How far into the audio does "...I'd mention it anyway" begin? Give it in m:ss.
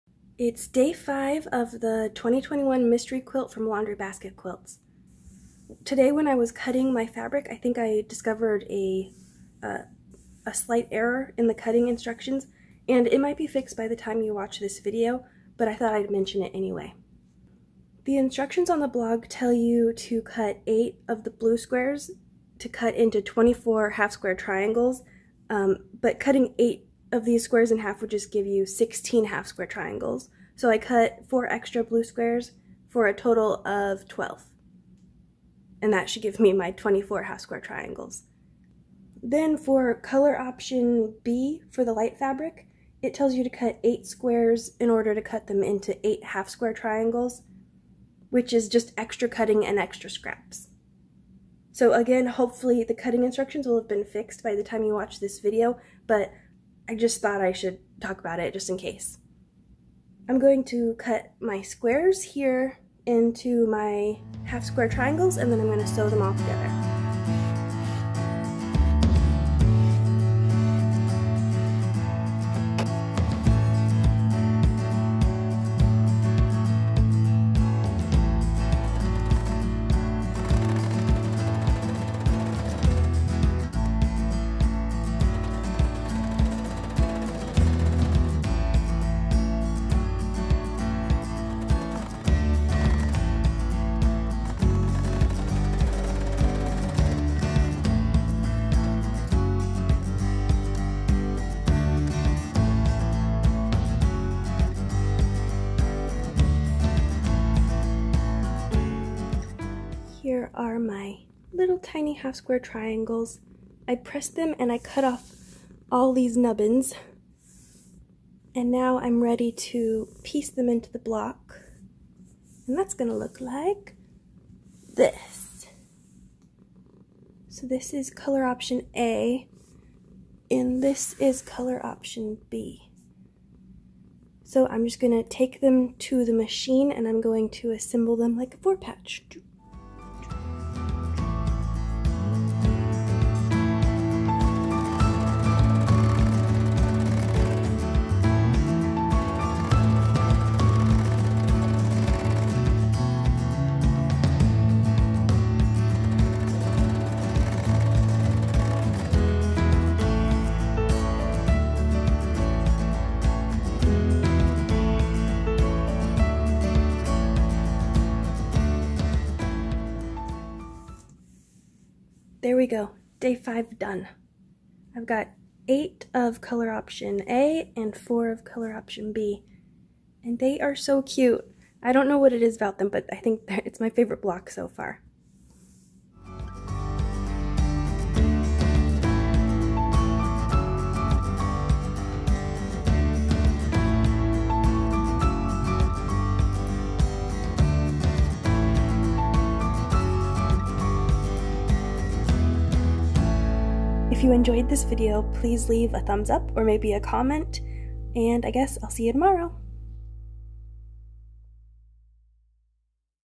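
0:15.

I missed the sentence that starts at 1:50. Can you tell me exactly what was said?
are my little tiny half square triangles.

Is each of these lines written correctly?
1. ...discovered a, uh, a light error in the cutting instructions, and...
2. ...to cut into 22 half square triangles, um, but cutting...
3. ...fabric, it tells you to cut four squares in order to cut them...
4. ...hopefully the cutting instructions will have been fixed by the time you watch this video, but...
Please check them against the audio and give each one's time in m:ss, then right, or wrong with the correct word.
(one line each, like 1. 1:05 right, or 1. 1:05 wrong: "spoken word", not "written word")
1. 0:08 wrong: "slight", not "light"
2. 0:22 wrong: "24", not "22"
3. 0:42 wrong: "eight", not "four"
4. 0:52 right.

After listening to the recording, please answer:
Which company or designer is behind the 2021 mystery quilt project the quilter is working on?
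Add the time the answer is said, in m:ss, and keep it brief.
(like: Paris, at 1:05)
Laundry Basket Quilts, at 0:03.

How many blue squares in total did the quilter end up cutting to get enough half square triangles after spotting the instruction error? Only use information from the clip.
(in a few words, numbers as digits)
12.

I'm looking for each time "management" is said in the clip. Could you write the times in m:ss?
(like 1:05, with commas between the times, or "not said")
not said.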